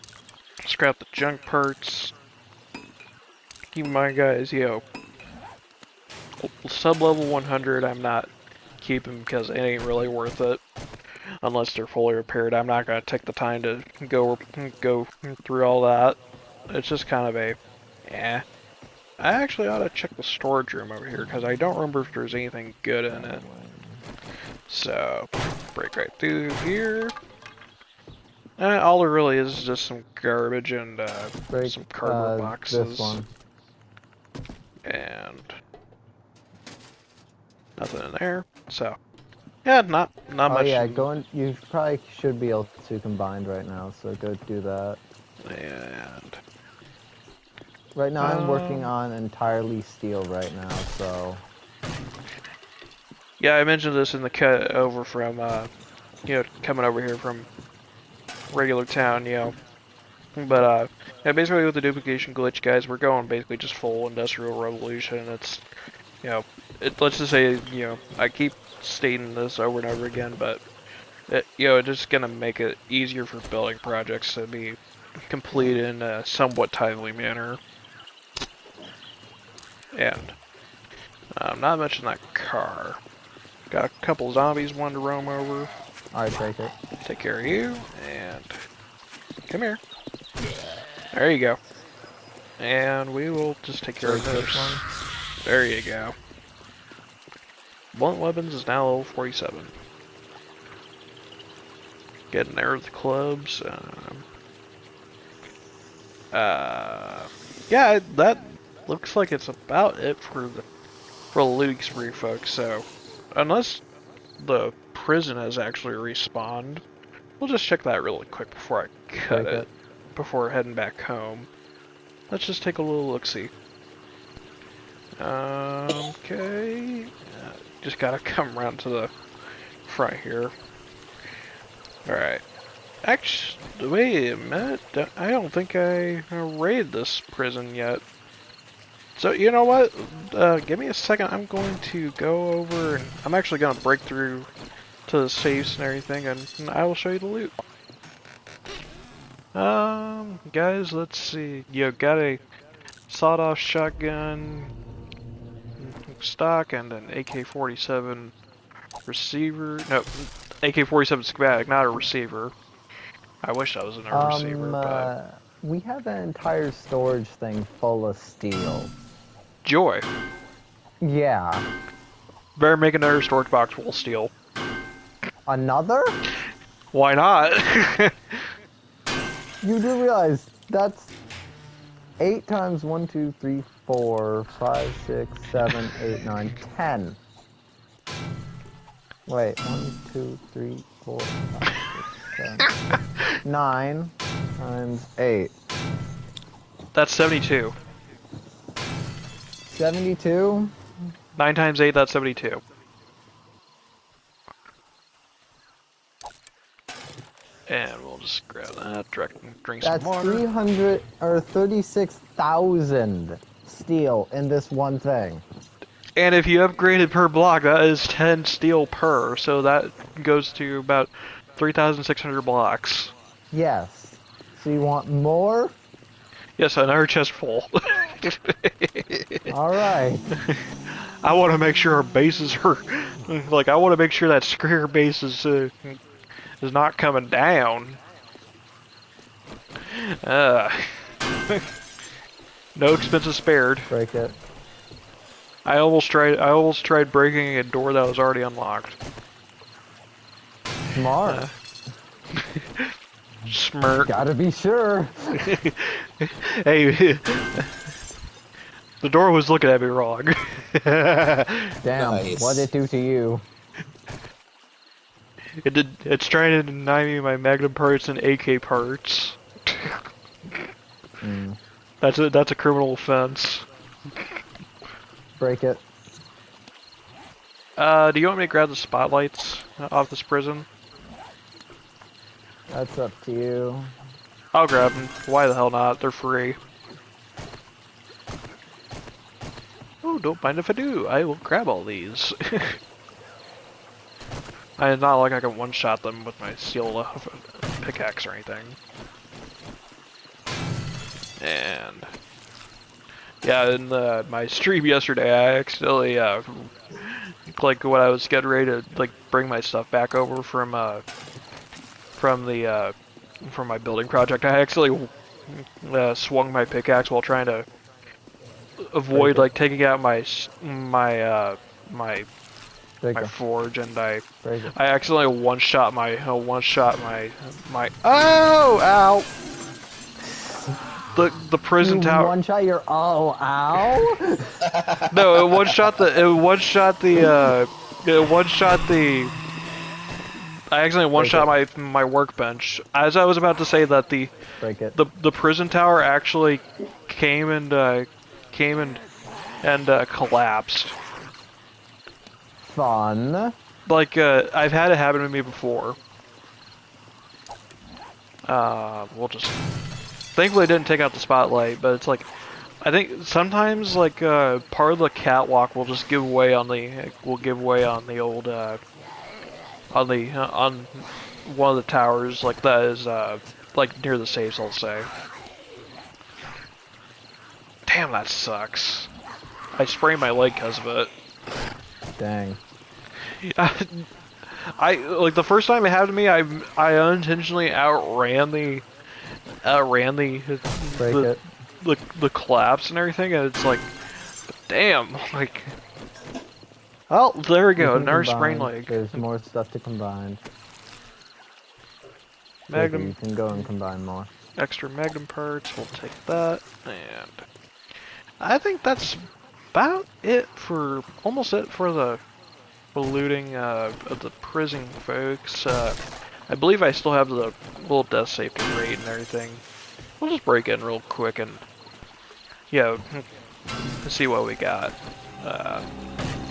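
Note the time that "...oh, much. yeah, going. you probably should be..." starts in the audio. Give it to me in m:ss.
0:40.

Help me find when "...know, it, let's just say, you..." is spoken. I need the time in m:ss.
1:06.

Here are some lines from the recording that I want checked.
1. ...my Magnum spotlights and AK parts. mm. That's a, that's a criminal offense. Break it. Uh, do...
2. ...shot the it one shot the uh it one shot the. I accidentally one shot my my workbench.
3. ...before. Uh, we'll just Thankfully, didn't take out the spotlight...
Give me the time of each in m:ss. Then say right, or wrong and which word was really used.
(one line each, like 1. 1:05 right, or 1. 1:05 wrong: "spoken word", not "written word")
1. 4:27 wrong: "parts", not "spotlights"
2. 5:35 right
3. 5:55 right.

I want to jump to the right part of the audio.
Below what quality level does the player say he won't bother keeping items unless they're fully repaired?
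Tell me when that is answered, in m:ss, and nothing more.
0:06.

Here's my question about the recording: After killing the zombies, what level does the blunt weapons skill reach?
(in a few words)
47.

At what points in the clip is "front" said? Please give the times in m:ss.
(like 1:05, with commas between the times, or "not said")
2:09.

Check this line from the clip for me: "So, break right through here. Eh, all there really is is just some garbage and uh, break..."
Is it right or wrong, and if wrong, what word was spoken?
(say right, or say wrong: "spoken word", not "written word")
right.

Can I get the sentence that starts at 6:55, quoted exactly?
Uh, I believe I still have the little death safety rate and everything.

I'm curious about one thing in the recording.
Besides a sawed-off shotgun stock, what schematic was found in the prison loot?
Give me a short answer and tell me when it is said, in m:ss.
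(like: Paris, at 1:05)
AK-47 schematic, at 2:40.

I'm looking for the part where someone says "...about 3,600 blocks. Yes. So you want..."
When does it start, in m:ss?
3:40.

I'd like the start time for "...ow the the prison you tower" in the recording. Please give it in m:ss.
5:28.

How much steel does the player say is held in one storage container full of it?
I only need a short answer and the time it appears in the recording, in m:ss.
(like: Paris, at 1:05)
36,000, at 3:31.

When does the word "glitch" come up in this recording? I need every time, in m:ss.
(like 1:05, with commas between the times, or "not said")
1:02.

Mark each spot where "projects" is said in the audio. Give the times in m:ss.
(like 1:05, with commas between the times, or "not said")
1:13, 5:14.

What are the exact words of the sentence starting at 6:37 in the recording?
Oh, there we go, another sprain leg.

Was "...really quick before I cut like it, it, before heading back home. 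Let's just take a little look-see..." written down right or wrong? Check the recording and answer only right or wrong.
right.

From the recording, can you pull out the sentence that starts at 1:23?
Got a couple zombies, one to roam over.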